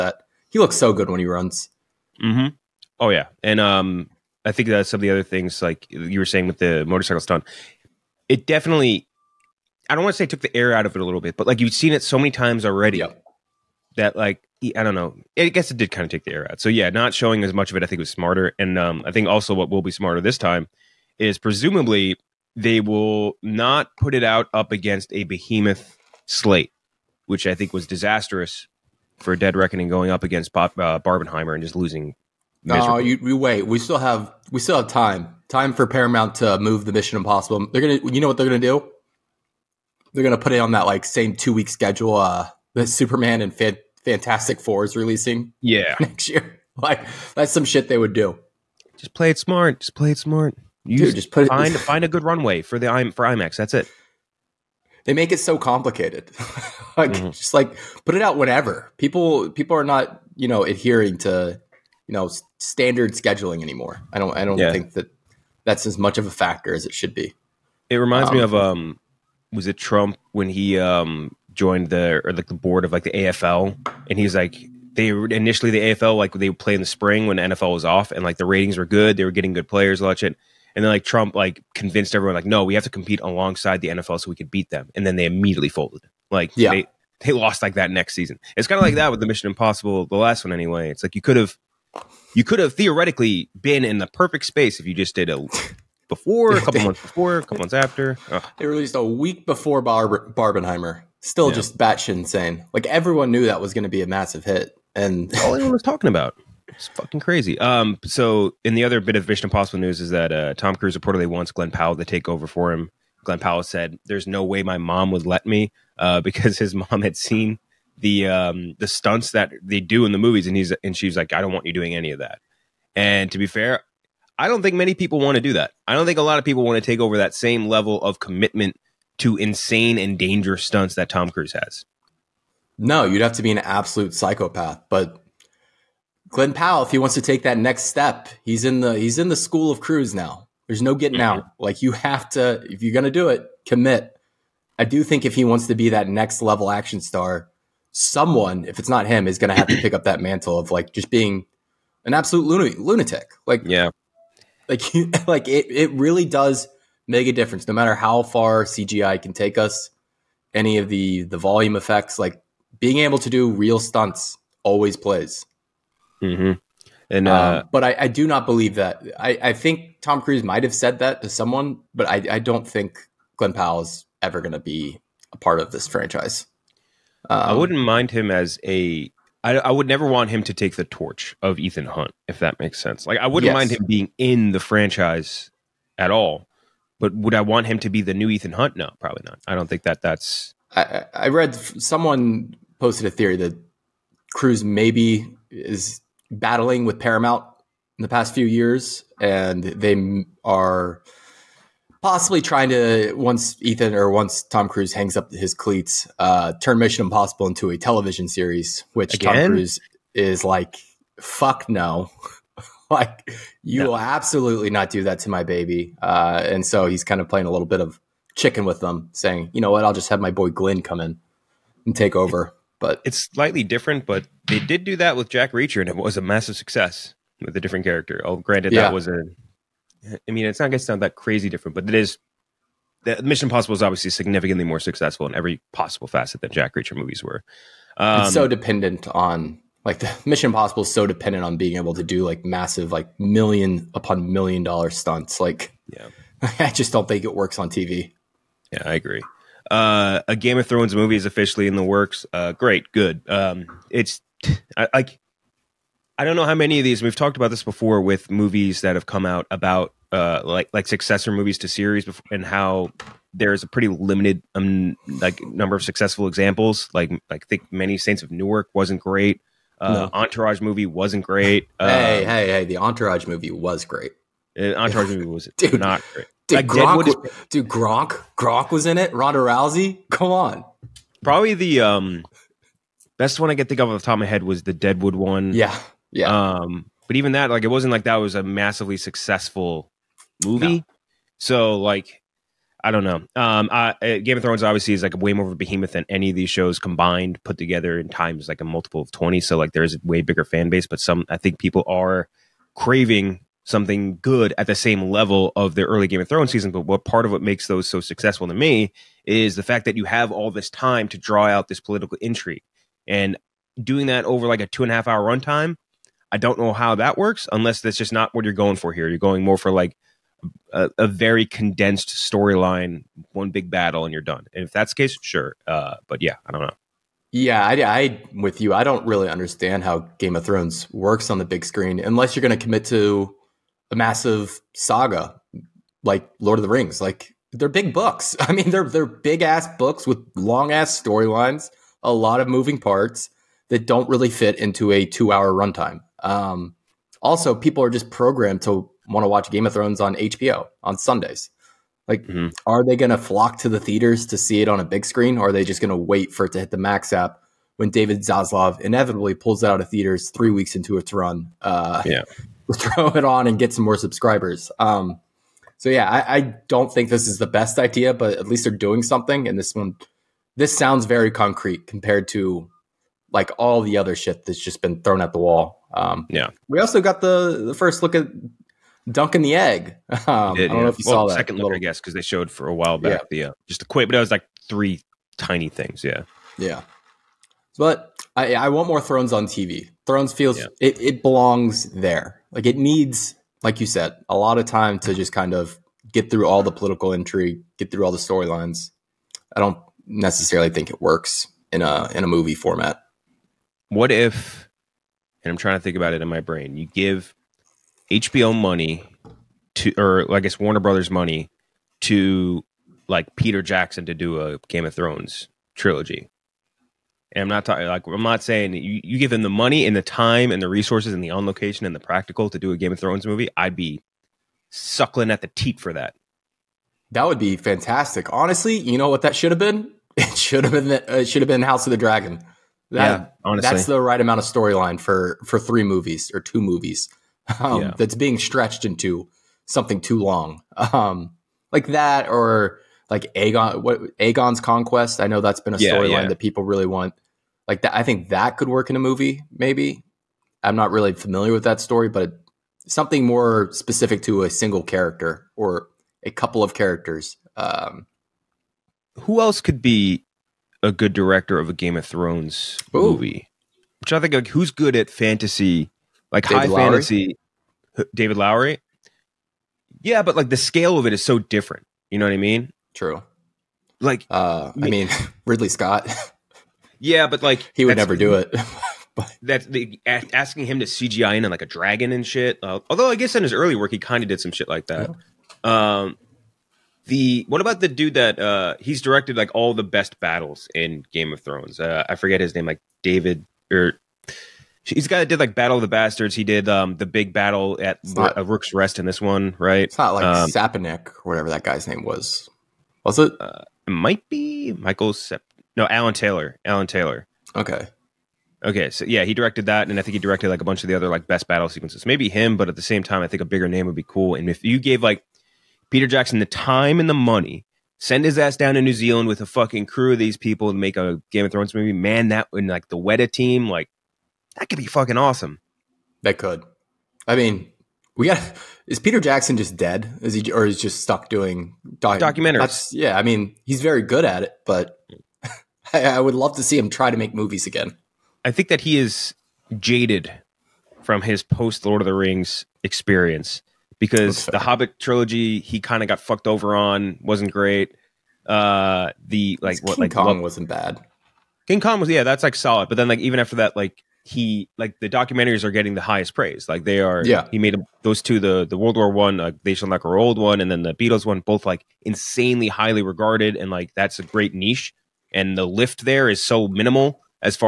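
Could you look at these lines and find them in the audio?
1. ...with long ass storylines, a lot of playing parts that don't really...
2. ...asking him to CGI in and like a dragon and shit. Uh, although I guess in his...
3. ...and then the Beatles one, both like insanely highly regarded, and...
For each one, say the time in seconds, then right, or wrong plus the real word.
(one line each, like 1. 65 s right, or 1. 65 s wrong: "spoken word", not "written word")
1. 340 s wrong: "moving", not "playing"
2. 480 s right
3. 560 s right.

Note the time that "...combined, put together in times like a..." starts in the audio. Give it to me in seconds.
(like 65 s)
296 s.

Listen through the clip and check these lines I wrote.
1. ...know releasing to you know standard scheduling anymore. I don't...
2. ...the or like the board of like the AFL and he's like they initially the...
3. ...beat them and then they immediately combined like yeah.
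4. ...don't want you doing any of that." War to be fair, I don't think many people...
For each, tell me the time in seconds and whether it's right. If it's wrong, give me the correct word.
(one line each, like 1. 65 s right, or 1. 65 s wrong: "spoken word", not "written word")
1. 60 s wrong: "adhering", not "releasing"
2. 71 s right
3. 84 s wrong: "folded", not "combined"
4. 121 s wrong: "And", not "War".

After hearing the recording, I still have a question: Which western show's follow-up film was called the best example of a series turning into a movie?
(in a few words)
Deadwood.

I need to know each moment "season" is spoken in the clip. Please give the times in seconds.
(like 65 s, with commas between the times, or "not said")
88 s, 306 s.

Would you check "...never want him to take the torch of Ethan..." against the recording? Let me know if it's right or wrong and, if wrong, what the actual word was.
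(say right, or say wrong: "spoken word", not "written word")
right.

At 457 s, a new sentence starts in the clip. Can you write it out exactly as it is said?
Um, Who else could be a good director of a Game of Thrones Ooh.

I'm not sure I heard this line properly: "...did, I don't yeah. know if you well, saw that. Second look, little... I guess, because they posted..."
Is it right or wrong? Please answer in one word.
wrong.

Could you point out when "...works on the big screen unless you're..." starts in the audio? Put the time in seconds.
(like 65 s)
330 s.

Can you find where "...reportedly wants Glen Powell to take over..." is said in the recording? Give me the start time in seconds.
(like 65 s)
110 s.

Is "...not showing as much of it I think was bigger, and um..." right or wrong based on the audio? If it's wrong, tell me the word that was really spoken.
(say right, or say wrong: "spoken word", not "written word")
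wrong: "smarter", not "bigger".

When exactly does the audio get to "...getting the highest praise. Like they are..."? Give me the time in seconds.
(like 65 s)
555 s.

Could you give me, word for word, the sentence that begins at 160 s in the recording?
Any of the the volume effects like being able to do real stunts always plays.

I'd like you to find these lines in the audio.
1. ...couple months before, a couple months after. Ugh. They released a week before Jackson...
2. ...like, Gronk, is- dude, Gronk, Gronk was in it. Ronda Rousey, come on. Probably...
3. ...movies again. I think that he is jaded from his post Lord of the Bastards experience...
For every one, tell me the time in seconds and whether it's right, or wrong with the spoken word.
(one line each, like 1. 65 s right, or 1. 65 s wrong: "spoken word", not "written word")
1. 96 s wrong: "Bar", not "Jackson"
2. 276 s right
3. 537 s wrong: "Rings", not "Bastards".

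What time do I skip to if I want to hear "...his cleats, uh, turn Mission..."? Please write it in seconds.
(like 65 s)
205 s.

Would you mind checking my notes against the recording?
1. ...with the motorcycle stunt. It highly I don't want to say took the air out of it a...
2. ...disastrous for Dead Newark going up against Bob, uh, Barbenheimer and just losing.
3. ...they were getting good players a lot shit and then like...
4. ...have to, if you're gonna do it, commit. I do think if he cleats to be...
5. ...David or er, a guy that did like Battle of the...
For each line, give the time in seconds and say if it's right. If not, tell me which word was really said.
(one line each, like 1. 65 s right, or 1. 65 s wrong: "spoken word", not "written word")
1. 6 s wrong: "definitely", not "highly"
2. 27 s wrong: "Reckoning", not "Newark"
3. 79 s right
4. 141 s wrong: "wants", not "cleats"
5. 493 s right.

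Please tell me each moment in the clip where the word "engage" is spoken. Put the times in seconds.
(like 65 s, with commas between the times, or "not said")
not said.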